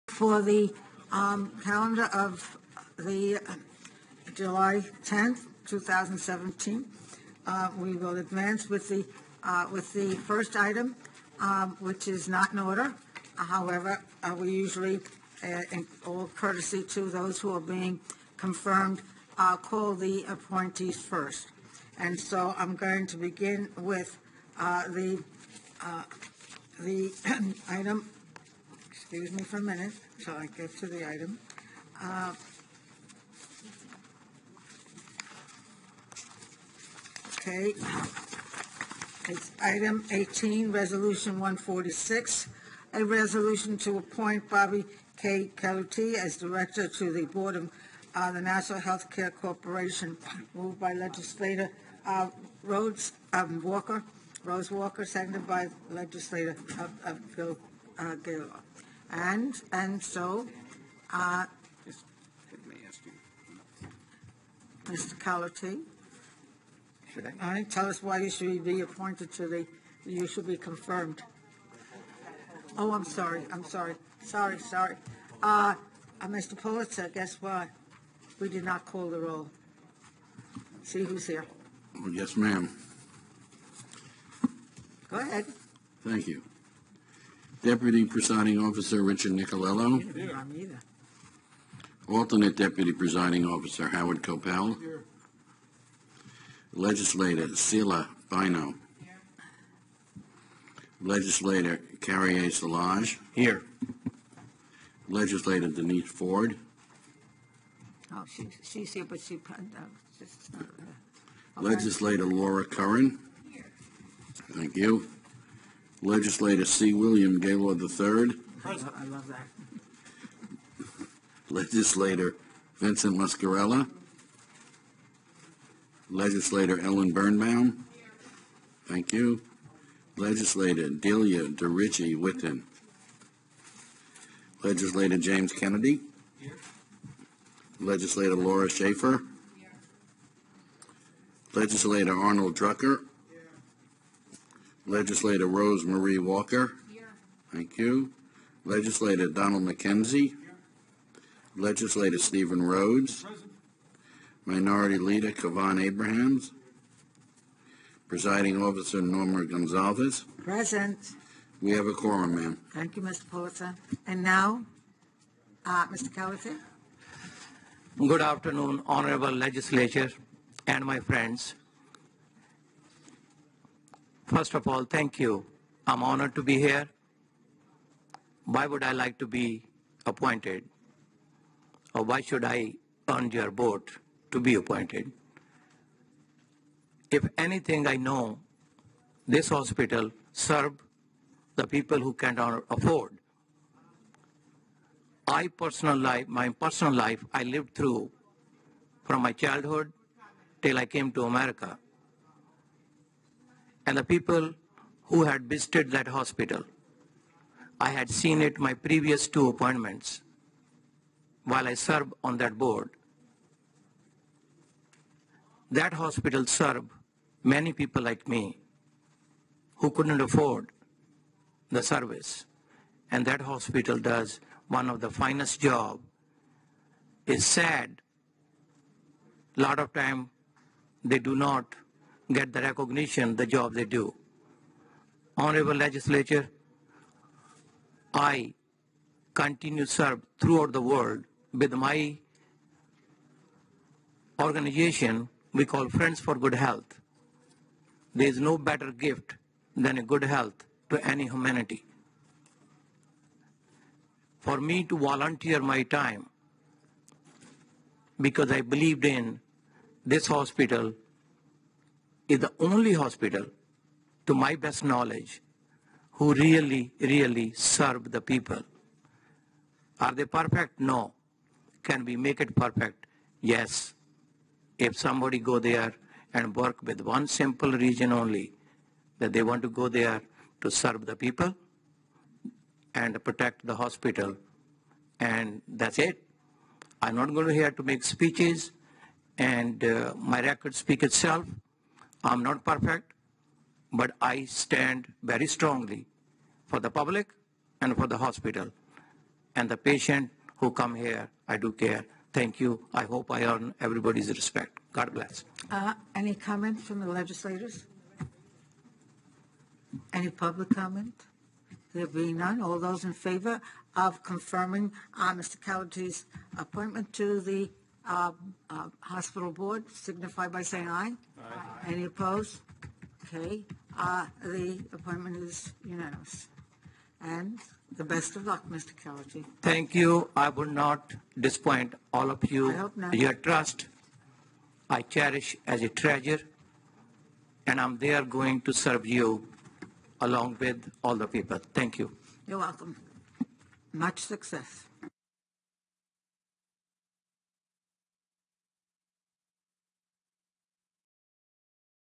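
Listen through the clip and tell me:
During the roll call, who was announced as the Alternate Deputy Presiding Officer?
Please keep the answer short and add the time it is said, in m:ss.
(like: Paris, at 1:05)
Howard Kopel, at 1:33.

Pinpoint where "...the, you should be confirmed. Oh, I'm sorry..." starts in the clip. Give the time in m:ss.
1:09.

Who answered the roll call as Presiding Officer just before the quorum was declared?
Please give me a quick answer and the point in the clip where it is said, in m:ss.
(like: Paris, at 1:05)
Norma Gonsalves, at 2:39.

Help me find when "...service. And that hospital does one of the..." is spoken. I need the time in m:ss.
3:41.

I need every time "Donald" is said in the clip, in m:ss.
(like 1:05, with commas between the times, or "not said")
2:29.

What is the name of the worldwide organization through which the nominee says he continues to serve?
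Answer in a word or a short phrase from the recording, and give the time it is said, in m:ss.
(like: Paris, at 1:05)
Friends for Good Health, at 4:05.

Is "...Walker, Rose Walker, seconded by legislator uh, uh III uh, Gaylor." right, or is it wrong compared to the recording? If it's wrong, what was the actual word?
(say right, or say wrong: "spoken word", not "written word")
wrong: "Bill", not "III".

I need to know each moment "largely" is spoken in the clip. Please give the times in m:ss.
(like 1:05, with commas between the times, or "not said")
not said.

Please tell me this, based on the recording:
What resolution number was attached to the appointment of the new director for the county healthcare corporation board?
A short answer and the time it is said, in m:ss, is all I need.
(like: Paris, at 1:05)
146, at 0:40.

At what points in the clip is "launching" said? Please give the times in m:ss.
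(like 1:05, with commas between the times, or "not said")
not said.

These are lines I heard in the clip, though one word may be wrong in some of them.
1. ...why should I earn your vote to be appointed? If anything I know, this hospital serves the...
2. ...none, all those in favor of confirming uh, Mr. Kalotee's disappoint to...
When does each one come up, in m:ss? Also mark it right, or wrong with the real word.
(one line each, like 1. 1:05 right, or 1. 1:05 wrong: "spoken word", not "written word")
1. 3:02 right
2. 5:12 wrong: "appointment", not "disappoint".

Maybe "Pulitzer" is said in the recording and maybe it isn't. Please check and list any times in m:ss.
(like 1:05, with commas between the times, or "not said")
1:16, 2:43.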